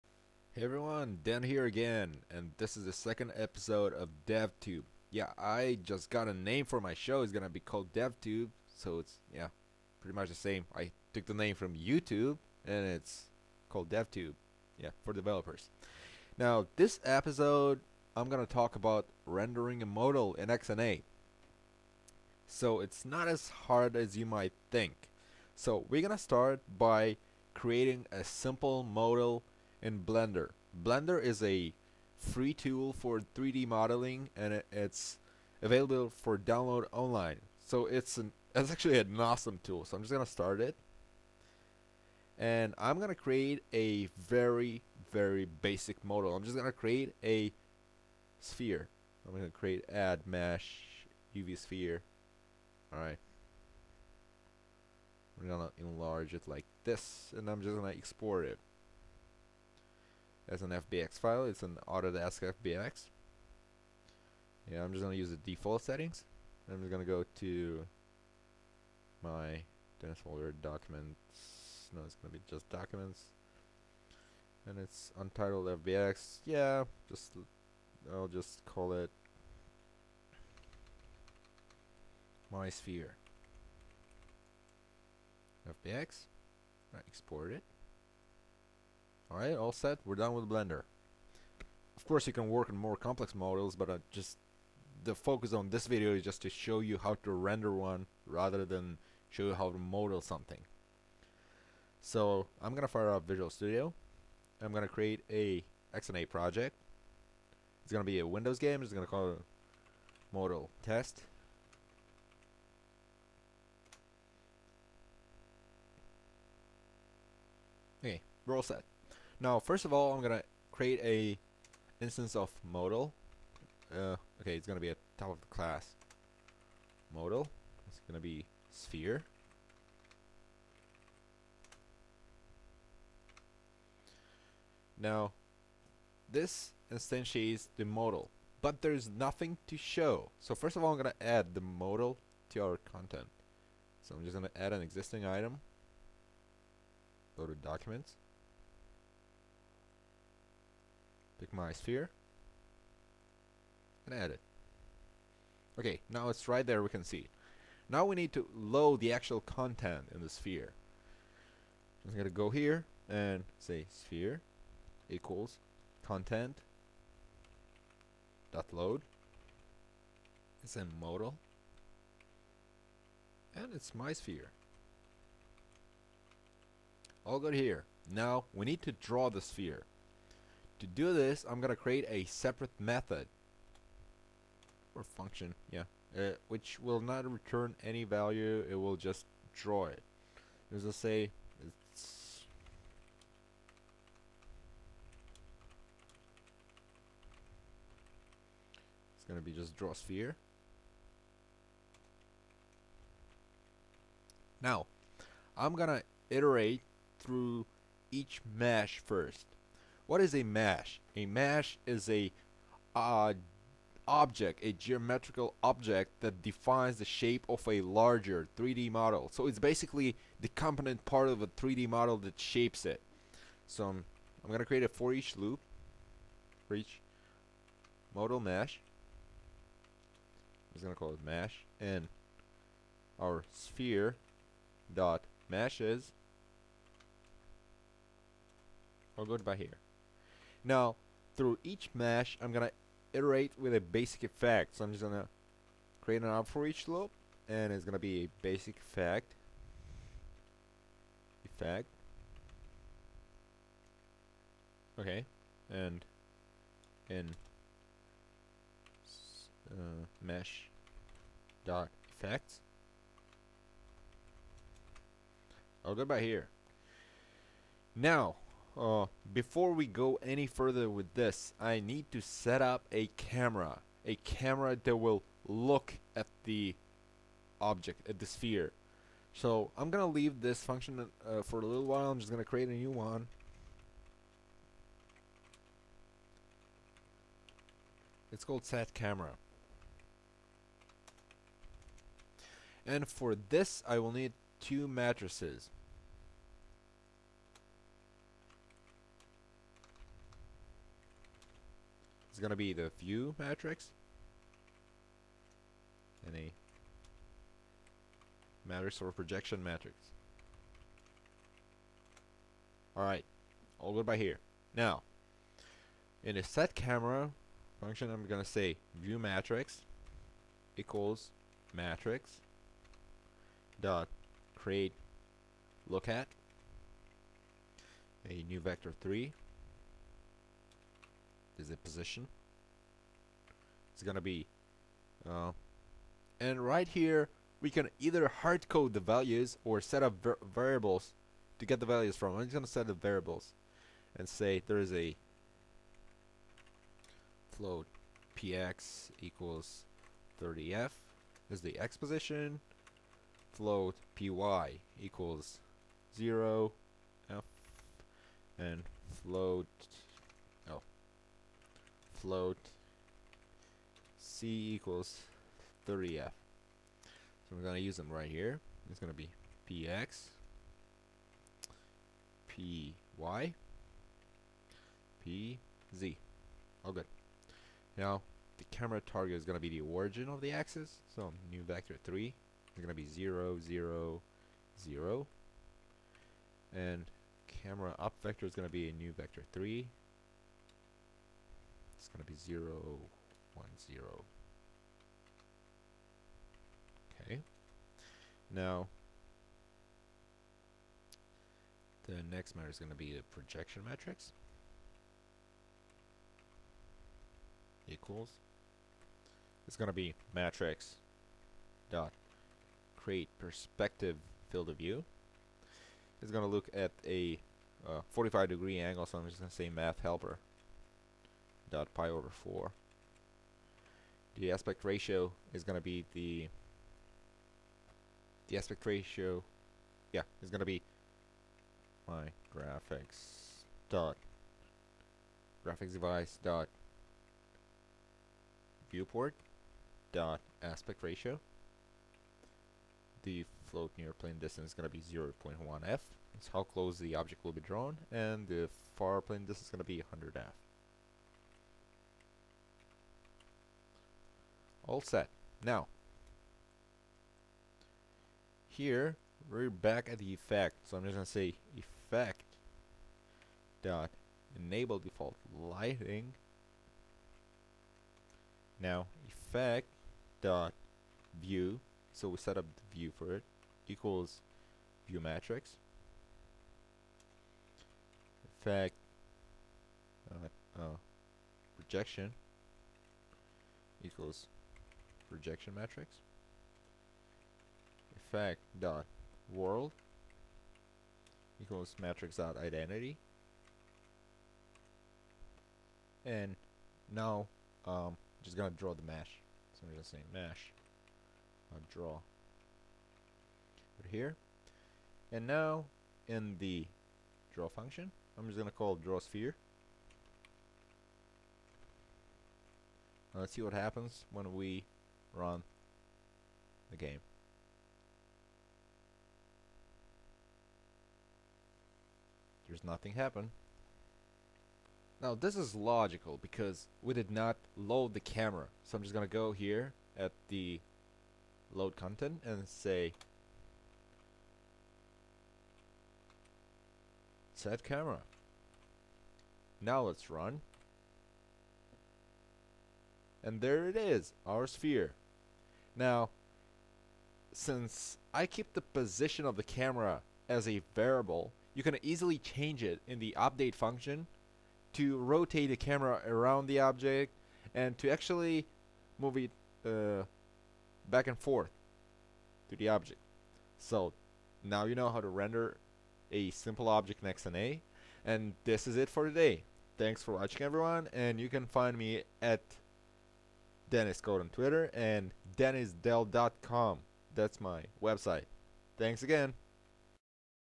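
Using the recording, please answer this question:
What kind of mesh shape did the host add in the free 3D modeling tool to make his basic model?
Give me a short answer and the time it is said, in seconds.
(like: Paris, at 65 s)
UV sphere, at 51 s.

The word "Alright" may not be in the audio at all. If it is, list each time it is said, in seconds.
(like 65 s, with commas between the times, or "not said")
52 s, 89 s, 312 s.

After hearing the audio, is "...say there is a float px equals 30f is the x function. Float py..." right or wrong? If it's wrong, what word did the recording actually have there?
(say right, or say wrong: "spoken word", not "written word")
wrong: "position", not "function".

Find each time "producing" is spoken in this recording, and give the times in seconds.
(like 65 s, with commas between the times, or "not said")
not said.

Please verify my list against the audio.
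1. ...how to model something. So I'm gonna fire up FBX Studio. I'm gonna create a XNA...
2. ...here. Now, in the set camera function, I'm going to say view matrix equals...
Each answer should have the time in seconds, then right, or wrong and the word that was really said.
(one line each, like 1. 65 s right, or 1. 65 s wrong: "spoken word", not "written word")
1. 99 s wrong: "Visual", not "FBX"
2. 314 s right.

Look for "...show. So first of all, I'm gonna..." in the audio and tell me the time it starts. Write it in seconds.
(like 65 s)
139 s.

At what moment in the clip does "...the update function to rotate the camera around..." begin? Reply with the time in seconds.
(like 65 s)
553 s.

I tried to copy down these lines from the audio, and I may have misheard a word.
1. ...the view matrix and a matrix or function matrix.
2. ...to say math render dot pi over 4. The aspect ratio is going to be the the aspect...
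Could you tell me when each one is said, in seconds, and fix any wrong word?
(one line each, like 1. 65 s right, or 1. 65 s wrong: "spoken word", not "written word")
1. 302 s wrong: "projection", not "function"
2. 419 s wrong: "helper", not "render".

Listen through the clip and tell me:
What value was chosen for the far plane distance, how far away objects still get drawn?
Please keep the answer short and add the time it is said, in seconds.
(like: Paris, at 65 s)
100f, at 450 s.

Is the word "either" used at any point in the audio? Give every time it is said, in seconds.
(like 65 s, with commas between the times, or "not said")
337 s.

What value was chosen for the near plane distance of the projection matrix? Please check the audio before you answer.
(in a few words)
0.1f.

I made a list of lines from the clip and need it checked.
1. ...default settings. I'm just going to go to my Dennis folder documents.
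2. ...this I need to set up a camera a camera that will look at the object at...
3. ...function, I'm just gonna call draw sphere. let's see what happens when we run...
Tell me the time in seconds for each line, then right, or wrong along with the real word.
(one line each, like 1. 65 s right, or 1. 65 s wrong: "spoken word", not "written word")
1. 65 s right
2. 271 s right
3. 507 s right.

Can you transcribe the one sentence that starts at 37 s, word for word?
So it's an it's actually an awesome tool.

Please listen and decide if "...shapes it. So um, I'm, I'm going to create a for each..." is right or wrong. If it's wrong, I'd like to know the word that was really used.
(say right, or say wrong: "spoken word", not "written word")
right.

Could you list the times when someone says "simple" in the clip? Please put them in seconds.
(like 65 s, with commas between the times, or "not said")
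28 s, 566 s.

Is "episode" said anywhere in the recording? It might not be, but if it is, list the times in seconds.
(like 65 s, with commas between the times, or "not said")
3 s, 17 s.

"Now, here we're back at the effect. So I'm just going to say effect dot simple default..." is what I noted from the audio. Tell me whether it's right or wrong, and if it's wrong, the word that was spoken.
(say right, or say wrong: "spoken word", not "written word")
wrong: "enable", not "simple".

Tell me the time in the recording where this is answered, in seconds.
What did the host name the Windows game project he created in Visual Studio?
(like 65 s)
110 s.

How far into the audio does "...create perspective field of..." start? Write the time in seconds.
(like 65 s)
412 s.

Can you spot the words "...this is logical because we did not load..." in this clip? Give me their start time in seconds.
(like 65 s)
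525 s.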